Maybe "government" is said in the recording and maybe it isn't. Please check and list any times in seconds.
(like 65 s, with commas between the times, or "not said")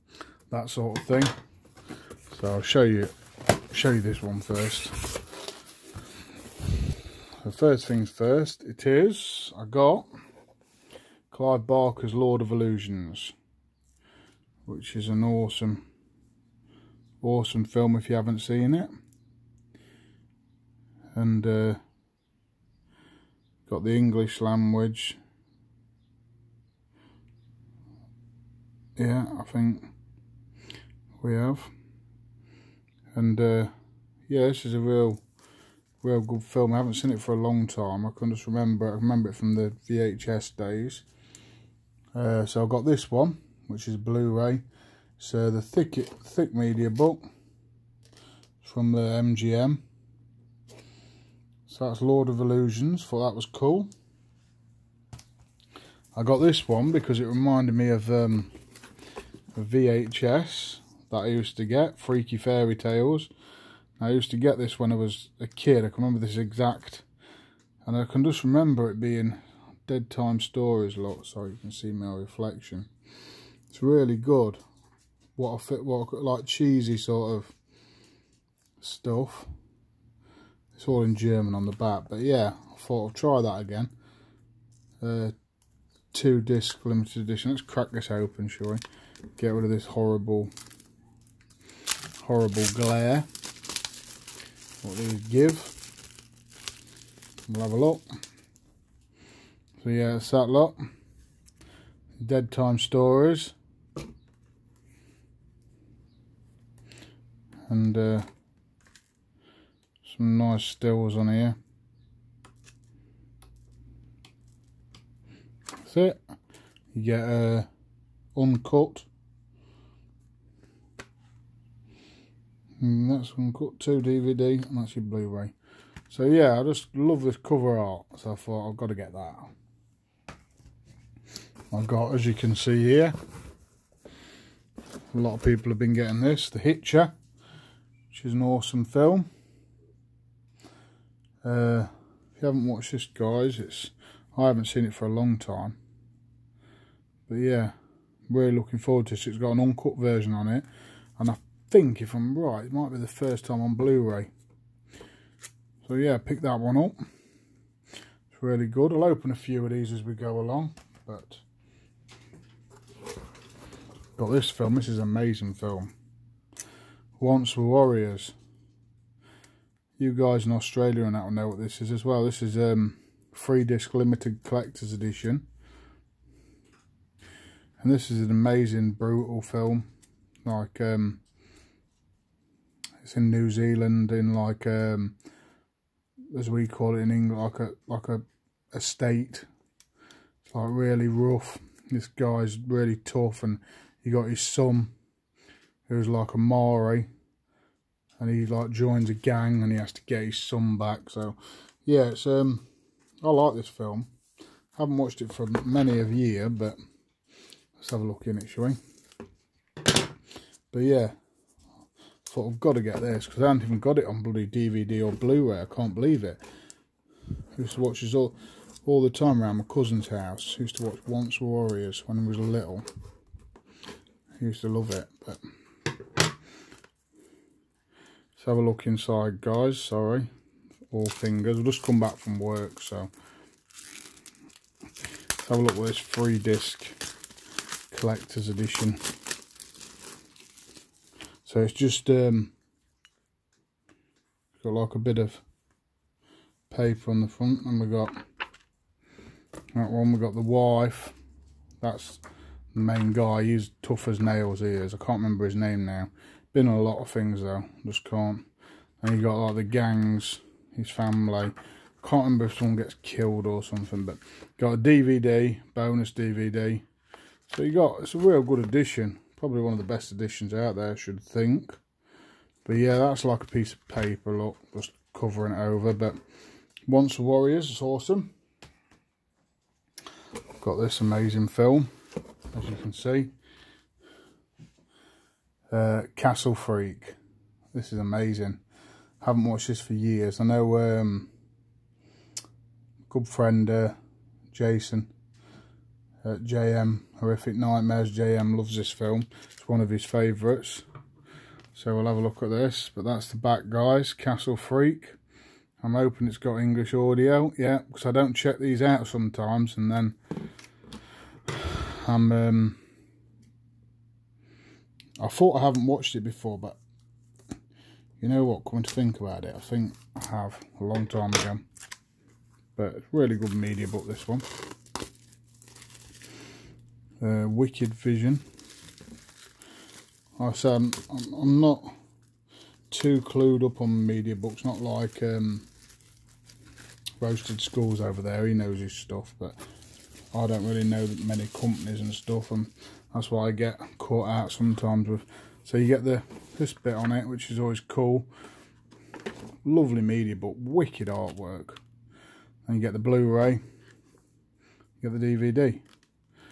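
not said.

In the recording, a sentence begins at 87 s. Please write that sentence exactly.
Let's crack this open, shall we?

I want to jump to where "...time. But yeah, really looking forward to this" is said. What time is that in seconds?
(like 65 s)
145 s.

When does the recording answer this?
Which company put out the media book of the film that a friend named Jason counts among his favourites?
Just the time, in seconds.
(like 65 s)
327 s.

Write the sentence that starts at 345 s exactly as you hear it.
So you get the this bit on it, which is always cool.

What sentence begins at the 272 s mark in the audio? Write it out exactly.
But yeah, that's like a piece of paper, look, just covering it over.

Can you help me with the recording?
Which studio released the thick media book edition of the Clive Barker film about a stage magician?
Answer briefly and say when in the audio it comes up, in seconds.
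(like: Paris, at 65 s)
MGM, at 49 s.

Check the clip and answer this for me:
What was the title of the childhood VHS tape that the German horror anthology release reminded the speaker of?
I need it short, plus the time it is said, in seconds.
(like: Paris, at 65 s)
Freaky Fairy Tales, at 61 s.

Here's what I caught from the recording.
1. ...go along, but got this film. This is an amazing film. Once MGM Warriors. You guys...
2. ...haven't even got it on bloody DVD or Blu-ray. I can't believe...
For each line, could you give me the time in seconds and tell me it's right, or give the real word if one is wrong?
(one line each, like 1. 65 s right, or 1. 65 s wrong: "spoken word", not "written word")
1. 160 s wrong: "Were", not "MGM"
2. 213 s right.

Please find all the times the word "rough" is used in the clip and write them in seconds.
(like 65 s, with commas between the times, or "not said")
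191 s.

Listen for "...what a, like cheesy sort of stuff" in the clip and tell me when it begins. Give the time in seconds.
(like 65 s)
75 s.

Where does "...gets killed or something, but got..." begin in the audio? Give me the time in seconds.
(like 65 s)
262 s.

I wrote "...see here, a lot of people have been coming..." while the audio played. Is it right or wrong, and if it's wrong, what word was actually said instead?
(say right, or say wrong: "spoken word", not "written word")
wrong: "getting", not "coming".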